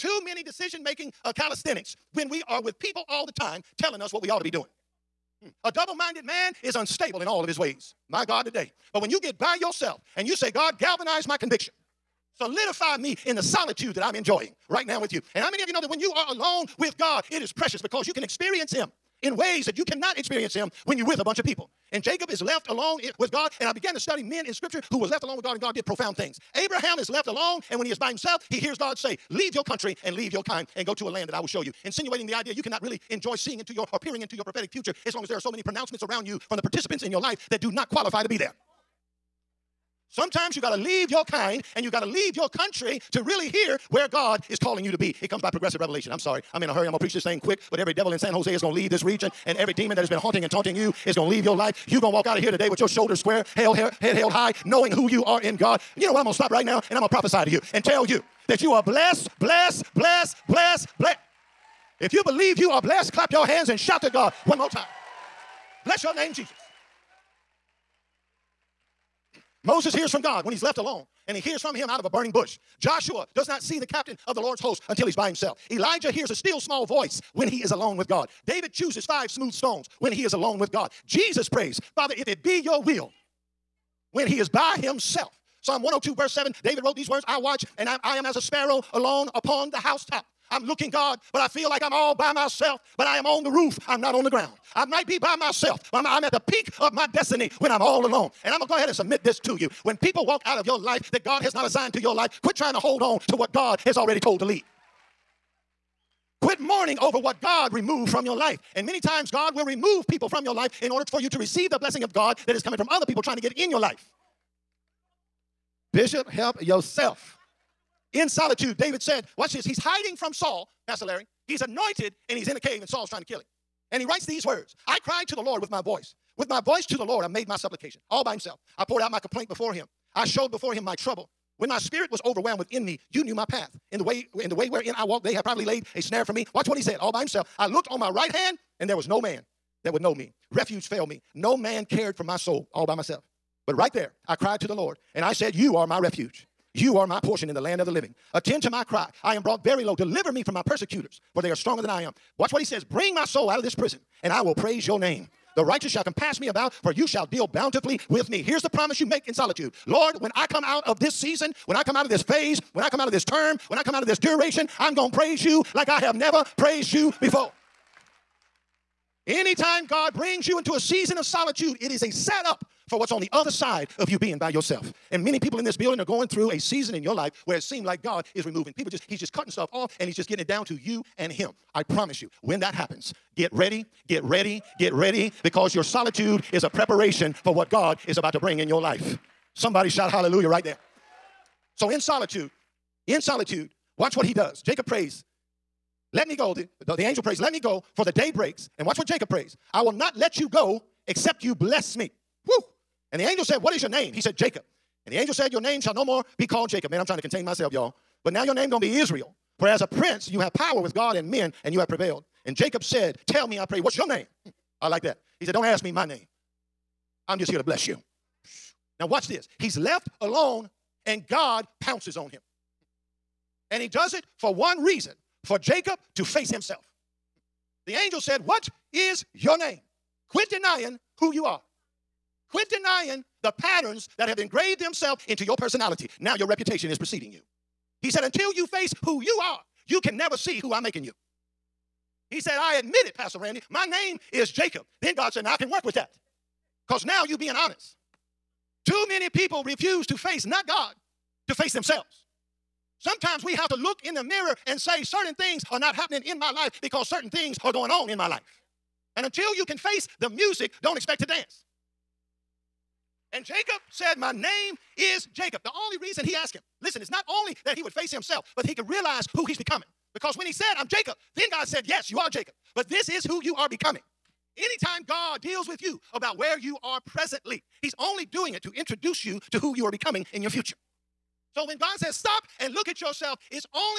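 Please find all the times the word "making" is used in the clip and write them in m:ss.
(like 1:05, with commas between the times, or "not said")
0:00, 4:00.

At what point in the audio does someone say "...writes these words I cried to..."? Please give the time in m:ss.
2:04.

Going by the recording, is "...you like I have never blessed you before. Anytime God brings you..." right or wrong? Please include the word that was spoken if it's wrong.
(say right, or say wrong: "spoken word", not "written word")
wrong: "praised", not "blessed".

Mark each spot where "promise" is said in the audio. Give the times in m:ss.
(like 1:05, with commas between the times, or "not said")
2:38, 3:01.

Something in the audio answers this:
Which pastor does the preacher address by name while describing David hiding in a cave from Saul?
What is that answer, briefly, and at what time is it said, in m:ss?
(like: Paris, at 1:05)
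Pastor Larry, at 2:00.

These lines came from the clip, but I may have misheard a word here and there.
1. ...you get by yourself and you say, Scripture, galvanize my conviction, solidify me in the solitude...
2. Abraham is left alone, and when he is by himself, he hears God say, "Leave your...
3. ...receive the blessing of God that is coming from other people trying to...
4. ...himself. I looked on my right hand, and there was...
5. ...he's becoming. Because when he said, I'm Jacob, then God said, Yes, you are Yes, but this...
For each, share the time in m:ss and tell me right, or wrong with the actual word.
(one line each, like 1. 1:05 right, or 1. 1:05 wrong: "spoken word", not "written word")
1. 0:09 wrong: "God", not "Scripture"
2. 0:26 right
3. 1:51 right
4. 2:17 right
5. 4:29 wrong: "Jacob", not "Yes".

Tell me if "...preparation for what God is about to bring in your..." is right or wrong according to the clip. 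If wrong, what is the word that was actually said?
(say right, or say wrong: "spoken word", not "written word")
right.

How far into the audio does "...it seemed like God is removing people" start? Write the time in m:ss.
2:57.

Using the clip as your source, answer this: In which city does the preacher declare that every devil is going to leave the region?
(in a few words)
San Jose.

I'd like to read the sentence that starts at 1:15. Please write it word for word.
Elijah hears a still small voice when he is alone with God.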